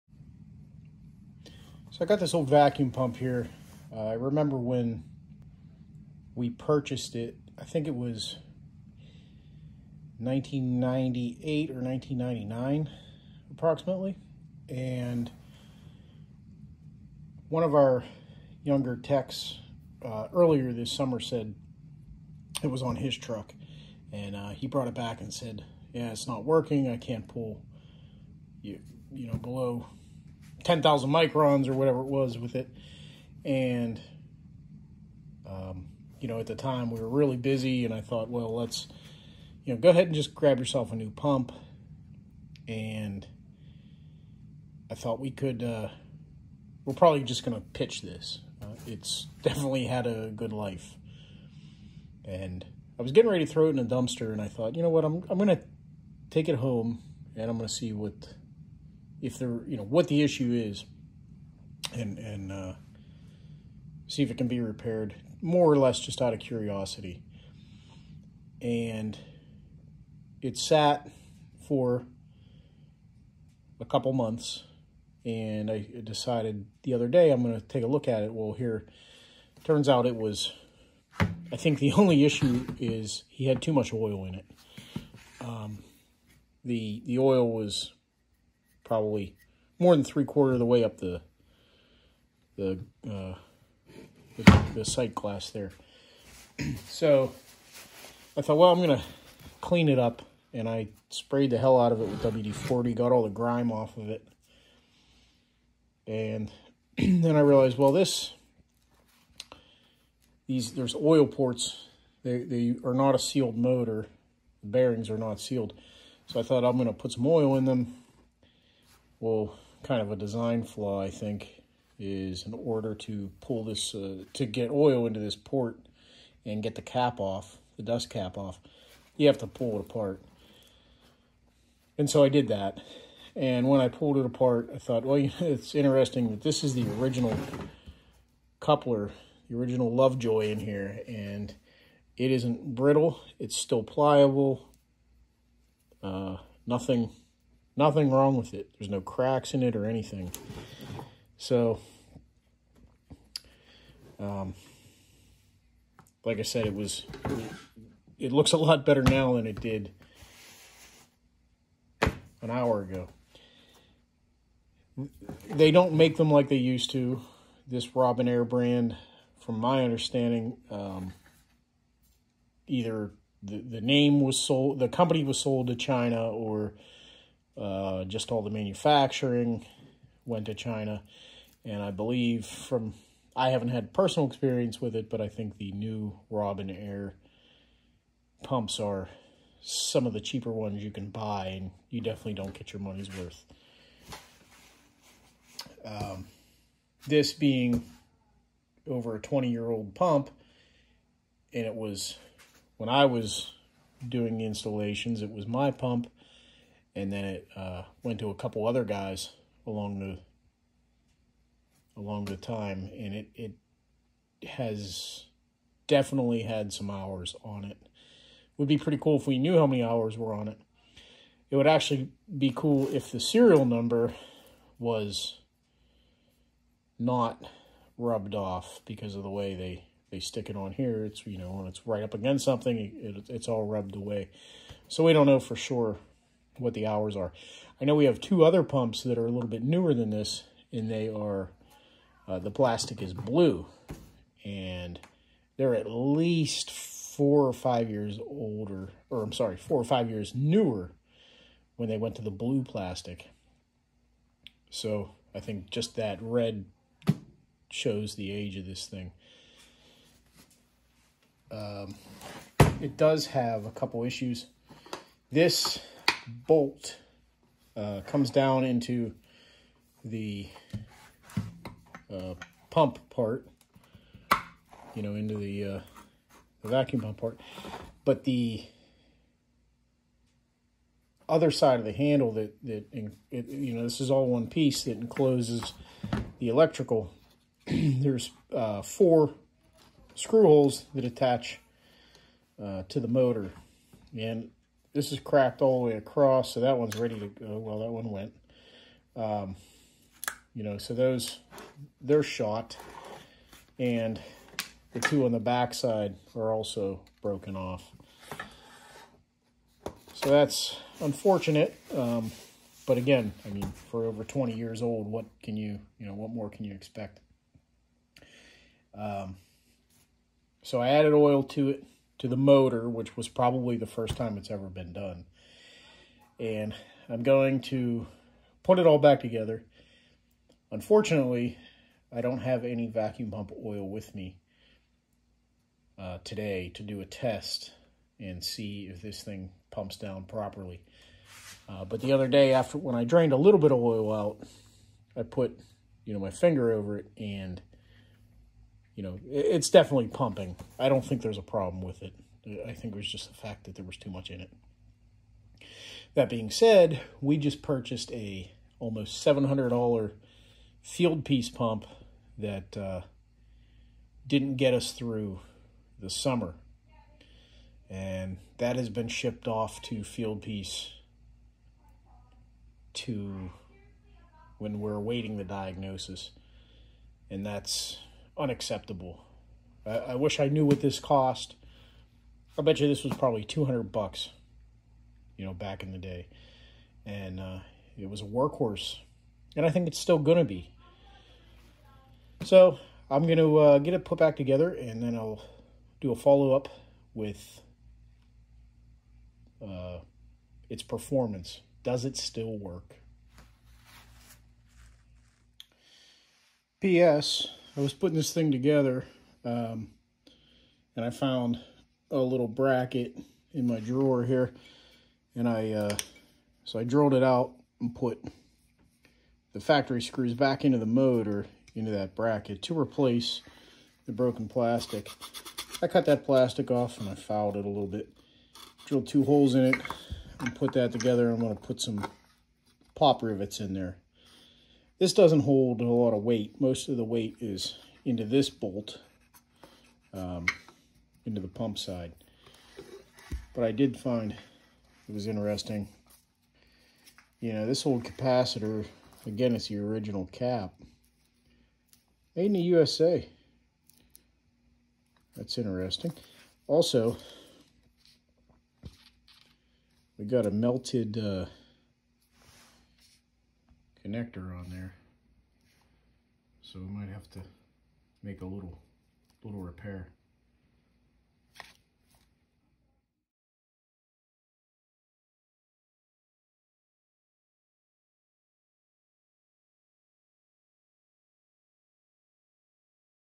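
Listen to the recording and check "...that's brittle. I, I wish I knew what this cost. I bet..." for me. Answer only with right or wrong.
wrong.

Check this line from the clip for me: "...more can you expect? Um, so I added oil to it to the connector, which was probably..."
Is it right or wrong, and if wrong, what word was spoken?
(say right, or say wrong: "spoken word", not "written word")
wrong: "motor", not "connector".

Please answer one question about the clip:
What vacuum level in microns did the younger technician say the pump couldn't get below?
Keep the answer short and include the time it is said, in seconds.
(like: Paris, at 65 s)
10,000 microns, at 30 s.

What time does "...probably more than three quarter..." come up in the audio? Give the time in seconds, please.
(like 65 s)
88 s.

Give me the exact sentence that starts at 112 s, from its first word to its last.
They they are not a sealed motor.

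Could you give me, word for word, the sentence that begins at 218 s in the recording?
Would be pretty cool if we knew how many hours were on it.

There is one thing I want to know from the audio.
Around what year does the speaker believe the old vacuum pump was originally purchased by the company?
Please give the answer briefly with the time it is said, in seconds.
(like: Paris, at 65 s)
1998, at 10 s.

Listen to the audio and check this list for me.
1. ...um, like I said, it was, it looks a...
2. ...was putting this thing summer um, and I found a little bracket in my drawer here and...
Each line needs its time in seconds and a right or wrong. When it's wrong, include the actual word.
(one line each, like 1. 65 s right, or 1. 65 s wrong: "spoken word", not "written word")
1. 154 s right
2. 407 s wrong: "together", not "summer".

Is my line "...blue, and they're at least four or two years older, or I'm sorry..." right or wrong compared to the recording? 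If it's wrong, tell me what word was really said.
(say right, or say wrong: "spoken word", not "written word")
wrong: "five", not "two".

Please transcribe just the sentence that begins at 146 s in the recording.
Uh, nothing Nothing wrong with it.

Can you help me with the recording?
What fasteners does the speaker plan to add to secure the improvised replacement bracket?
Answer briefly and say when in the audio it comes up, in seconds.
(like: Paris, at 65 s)
Pop rivets, at 432 s.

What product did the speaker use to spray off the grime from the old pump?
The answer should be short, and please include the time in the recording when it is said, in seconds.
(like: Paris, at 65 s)
WD-40, at 102 s.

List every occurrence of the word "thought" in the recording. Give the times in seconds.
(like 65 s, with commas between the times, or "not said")
38 s, 44 s, 54 s, 98 s, 116 s, 134 s.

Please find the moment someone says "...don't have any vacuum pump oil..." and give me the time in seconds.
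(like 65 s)
332 s.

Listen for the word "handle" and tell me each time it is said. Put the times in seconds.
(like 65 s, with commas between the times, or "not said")
281 s.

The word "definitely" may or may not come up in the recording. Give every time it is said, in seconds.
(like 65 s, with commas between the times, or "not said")
49 s, 192 s, 215 s, 349 s.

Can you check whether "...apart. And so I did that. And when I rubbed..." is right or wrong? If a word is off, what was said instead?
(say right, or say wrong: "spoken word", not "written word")
wrong: "pulled", not "rubbed".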